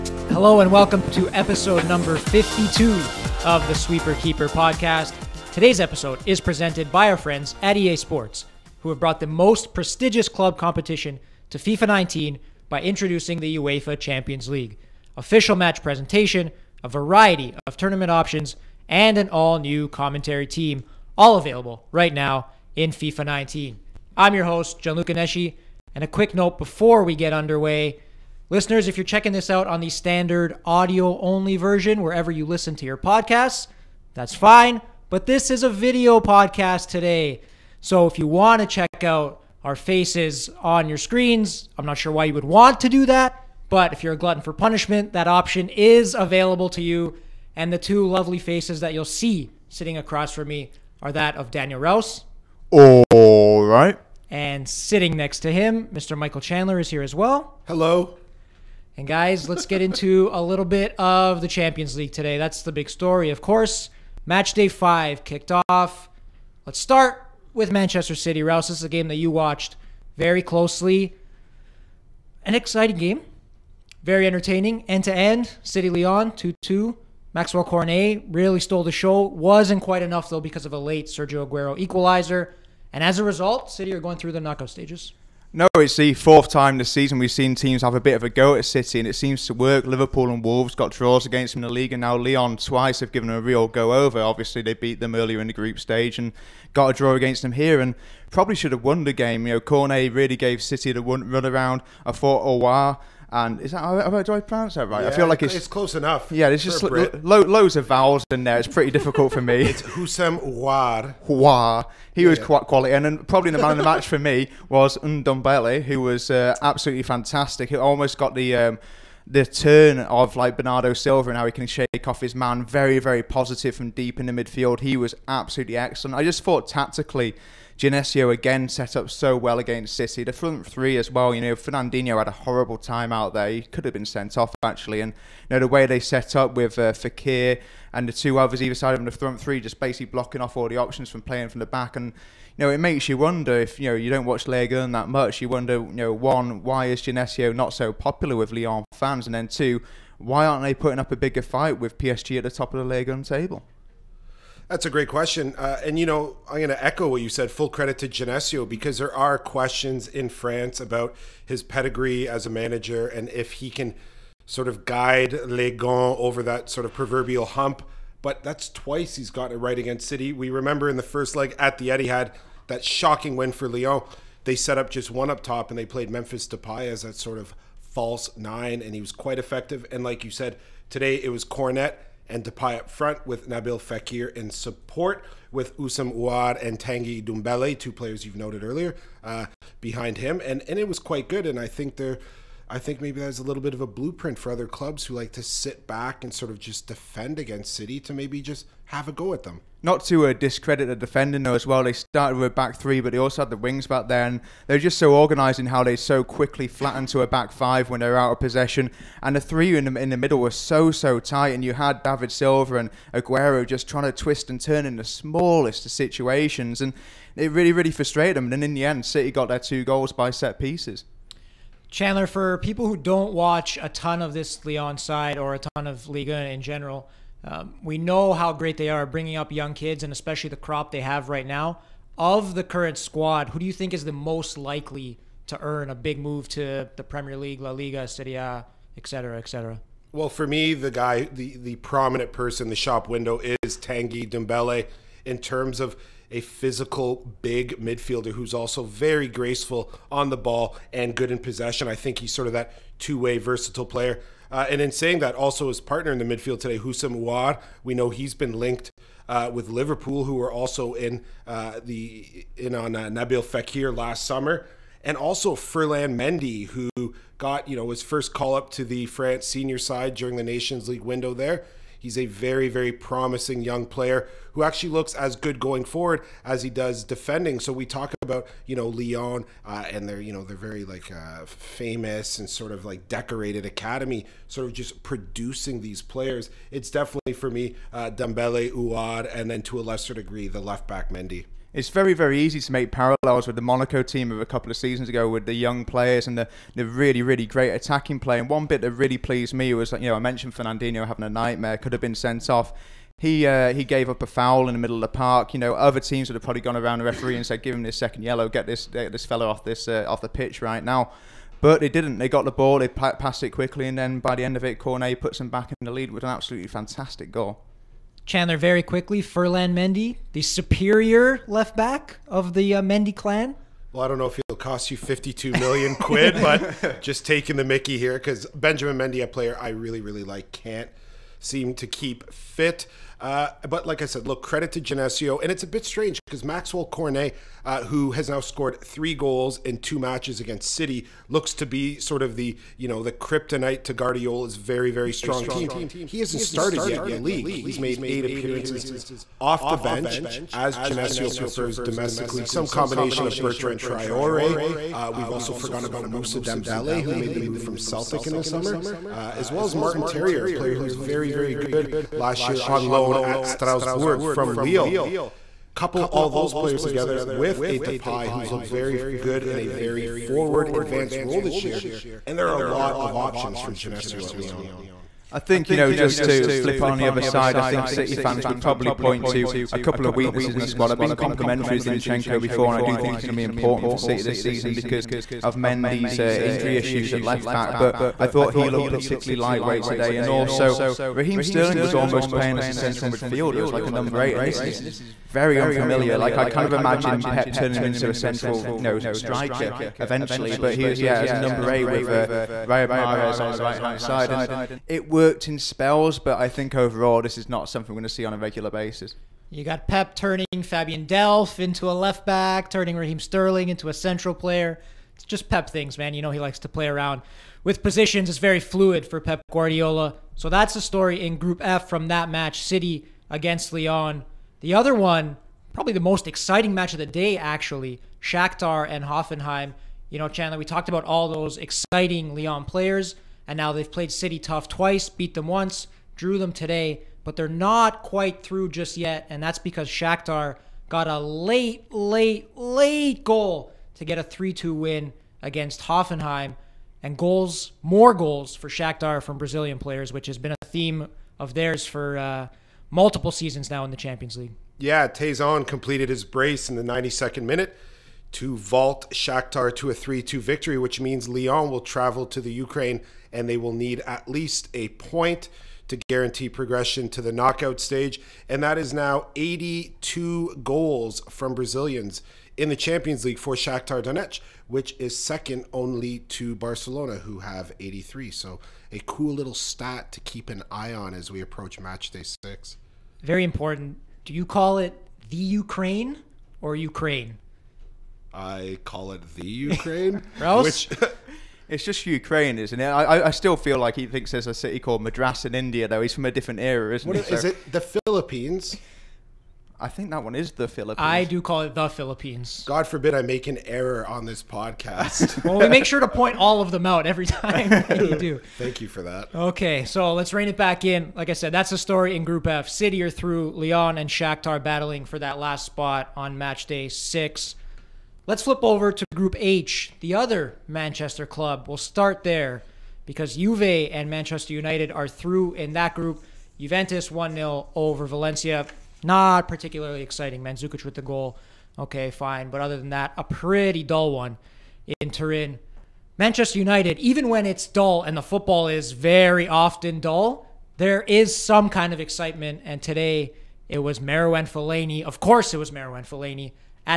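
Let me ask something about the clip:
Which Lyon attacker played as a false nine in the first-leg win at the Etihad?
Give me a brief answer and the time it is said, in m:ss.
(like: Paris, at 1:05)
Memphis Depay, at 2:56.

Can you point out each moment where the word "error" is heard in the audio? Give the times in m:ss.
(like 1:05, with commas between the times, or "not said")
8:23.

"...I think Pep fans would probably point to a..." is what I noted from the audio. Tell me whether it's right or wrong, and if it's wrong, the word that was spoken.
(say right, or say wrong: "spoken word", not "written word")
wrong: "City", not "Pep".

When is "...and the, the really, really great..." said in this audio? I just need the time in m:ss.
4:56.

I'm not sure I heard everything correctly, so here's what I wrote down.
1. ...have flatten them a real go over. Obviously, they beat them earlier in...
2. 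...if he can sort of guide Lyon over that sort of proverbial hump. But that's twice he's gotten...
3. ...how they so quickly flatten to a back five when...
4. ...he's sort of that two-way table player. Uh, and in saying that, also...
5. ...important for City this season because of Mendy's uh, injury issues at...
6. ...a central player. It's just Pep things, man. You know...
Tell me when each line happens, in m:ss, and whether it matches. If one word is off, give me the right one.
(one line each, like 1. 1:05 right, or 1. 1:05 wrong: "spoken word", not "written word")
1. 1:33 wrong: "given", not "flatten"
2. 2:43 right
3. 3:25 right
4. 4:12 wrong: "versatile", not "table"
5. 6:23 right
6. 6:53 right.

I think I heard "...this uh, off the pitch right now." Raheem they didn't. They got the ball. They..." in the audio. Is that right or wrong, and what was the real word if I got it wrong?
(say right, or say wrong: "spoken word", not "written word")
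wrong: "But", not "Raheem".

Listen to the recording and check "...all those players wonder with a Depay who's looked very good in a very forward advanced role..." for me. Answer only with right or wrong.
wrong.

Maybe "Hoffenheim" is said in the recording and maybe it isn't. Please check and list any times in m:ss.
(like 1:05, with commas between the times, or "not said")
7:09, 7:25.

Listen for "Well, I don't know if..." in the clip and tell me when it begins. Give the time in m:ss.
5:23.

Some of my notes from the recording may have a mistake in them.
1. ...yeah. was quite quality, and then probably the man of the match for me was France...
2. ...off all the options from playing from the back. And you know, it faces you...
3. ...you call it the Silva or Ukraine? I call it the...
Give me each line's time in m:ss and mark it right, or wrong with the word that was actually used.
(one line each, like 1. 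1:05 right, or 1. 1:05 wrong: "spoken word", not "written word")
1. 1:52 wrong: "Ndombele", not "France"
2. 2:20 wrong: "makes", not "faces"
3. 8:04 wrong: "Ukraine", not "Silva".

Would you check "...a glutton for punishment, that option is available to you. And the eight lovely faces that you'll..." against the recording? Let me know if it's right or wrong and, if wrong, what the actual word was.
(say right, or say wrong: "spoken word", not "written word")
wrong: "two", not "eight".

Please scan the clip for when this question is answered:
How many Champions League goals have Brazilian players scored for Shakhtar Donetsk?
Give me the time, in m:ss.
7:49.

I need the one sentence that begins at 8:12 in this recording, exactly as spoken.
I, I still feel like he thinks there's a city called Madras in India, though.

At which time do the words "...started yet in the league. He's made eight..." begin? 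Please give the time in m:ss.
5:46.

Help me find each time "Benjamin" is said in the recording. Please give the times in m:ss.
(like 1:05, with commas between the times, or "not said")
5:28.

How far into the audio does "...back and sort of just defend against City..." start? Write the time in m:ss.
3:15.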